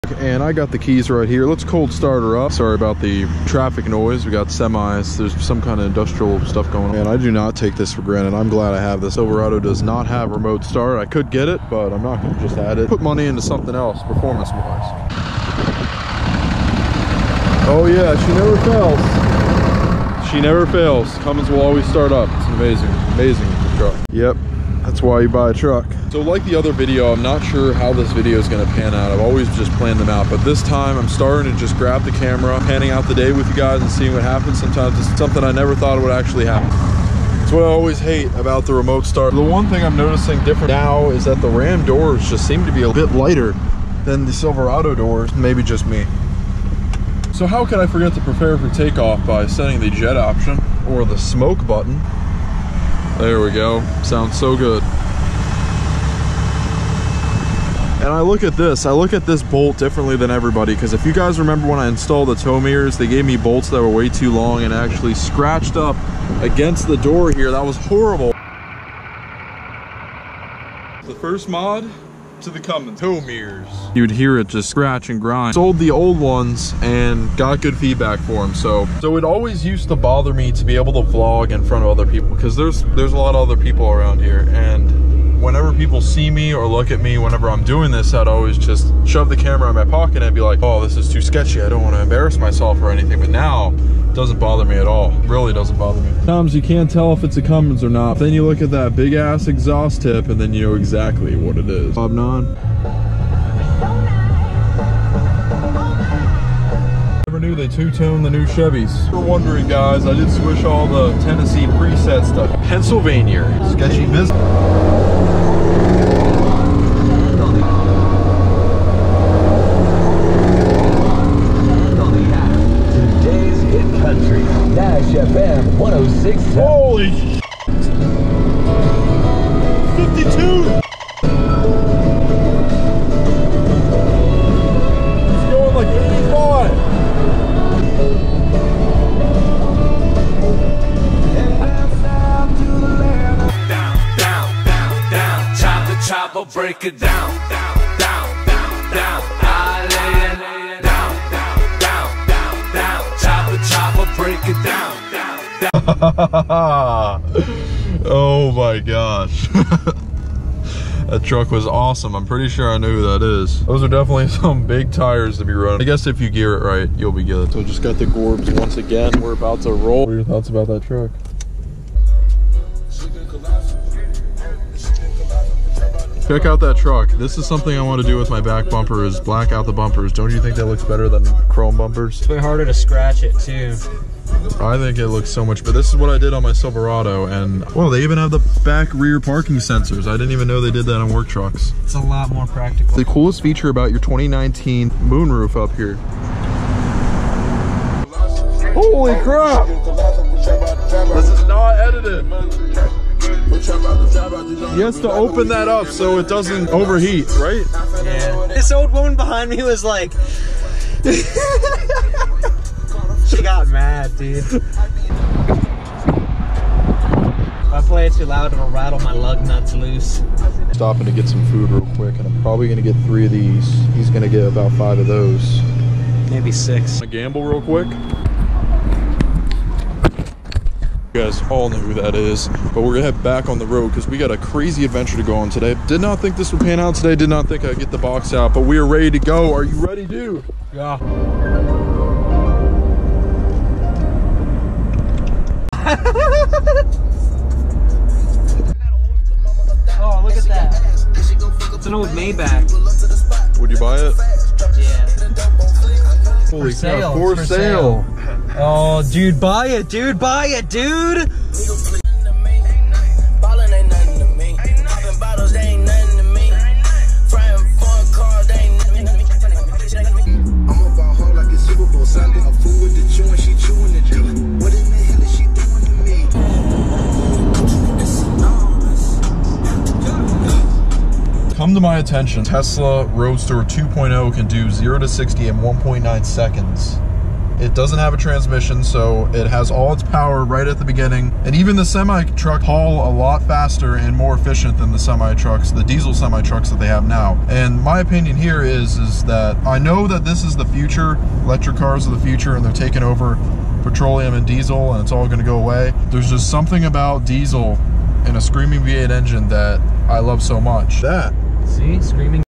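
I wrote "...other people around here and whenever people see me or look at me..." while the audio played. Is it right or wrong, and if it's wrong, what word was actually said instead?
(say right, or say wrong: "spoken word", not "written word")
right.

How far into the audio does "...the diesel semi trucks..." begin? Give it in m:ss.
4:55.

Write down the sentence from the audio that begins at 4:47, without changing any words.
It doesn't have a transmission, so it has all its power right at the beginning.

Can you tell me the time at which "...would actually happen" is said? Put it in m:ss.
0:35.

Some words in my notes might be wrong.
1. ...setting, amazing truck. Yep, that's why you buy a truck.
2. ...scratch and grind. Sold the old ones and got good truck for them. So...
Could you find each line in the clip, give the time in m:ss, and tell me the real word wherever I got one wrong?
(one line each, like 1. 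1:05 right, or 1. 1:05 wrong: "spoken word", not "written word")
1. 0:22 wrong: "amazing", not "setting"
2. 1:14 wrong: "feedback", not "truck".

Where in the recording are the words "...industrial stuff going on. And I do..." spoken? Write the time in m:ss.
0:05.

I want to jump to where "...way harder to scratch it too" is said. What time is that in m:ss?
3:02.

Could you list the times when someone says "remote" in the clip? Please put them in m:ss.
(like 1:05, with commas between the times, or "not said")
0:10, 0:38.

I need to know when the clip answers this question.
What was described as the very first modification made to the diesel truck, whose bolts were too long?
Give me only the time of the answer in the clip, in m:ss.
1:02.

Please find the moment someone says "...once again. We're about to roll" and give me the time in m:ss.
2:48.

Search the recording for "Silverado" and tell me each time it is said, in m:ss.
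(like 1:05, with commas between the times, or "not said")
0:09, 0:44, 3:06.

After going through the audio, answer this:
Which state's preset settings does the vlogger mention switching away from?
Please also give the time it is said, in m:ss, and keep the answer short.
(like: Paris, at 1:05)
Tennessee, at 1:51.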